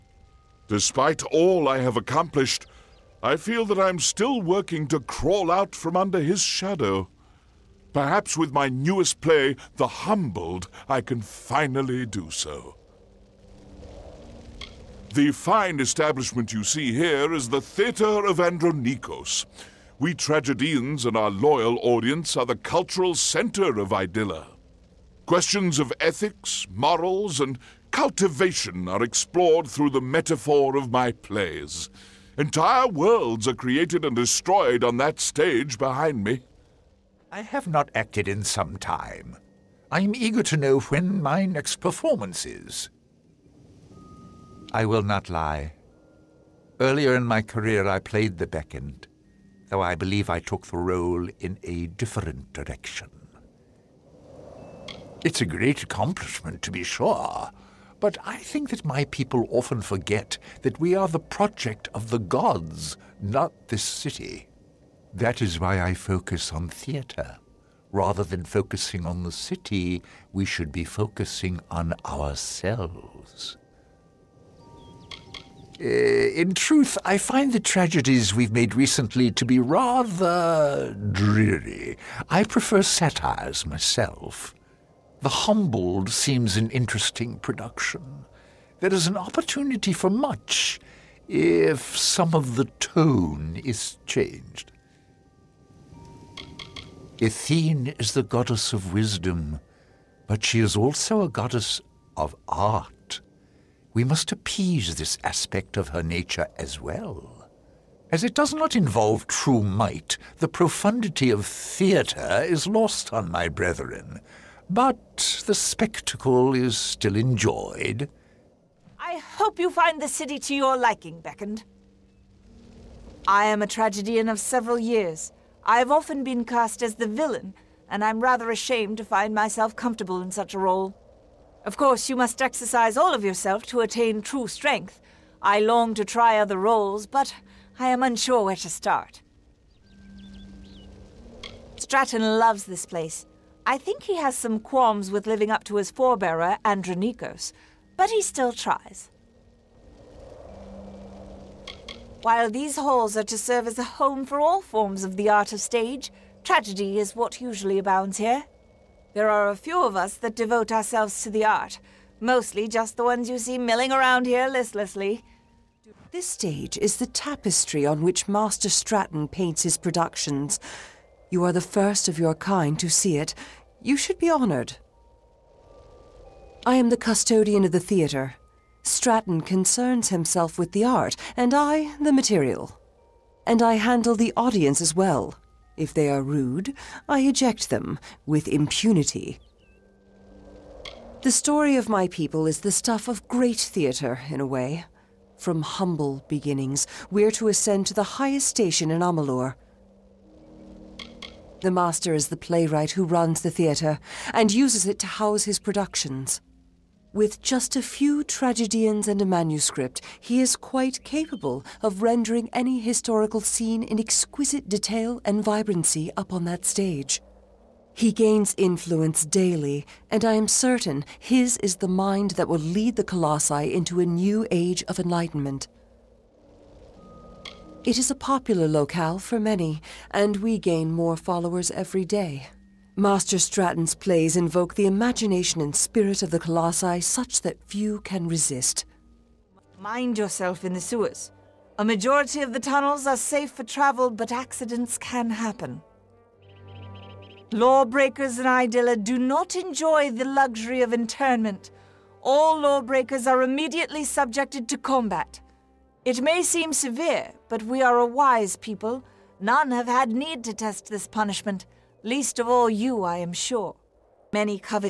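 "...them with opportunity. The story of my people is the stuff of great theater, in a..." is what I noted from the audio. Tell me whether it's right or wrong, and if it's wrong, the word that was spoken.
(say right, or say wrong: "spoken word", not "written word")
wrong: "impunity", not "opportunity".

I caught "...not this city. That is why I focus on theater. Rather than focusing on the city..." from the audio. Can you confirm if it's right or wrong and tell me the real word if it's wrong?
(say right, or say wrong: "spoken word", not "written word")
right.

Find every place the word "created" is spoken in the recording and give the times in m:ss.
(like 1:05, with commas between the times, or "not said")
0:33.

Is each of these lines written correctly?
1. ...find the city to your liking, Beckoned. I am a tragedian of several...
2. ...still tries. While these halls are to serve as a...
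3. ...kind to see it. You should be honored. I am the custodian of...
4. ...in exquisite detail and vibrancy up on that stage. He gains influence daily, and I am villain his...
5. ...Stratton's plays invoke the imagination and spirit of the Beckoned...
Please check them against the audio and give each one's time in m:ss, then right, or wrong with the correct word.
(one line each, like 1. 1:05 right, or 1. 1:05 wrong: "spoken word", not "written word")
1. 1:59 right
2. 2:28 right
3. 2:52 right
4. 3:33 wrong: "certain", not "villain"
5. 3:53 wrong: "Colossi", not "Beckoned".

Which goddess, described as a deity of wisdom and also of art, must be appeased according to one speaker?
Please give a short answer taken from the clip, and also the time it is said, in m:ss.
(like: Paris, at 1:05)
Athene, at 1:37.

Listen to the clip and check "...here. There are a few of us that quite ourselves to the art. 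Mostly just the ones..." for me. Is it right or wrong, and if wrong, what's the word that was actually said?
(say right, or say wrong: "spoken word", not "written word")
wrong: "devote", not "quite".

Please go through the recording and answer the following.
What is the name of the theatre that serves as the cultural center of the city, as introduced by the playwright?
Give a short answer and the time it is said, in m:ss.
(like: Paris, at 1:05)
Theatre of Andronikos, at 0:17.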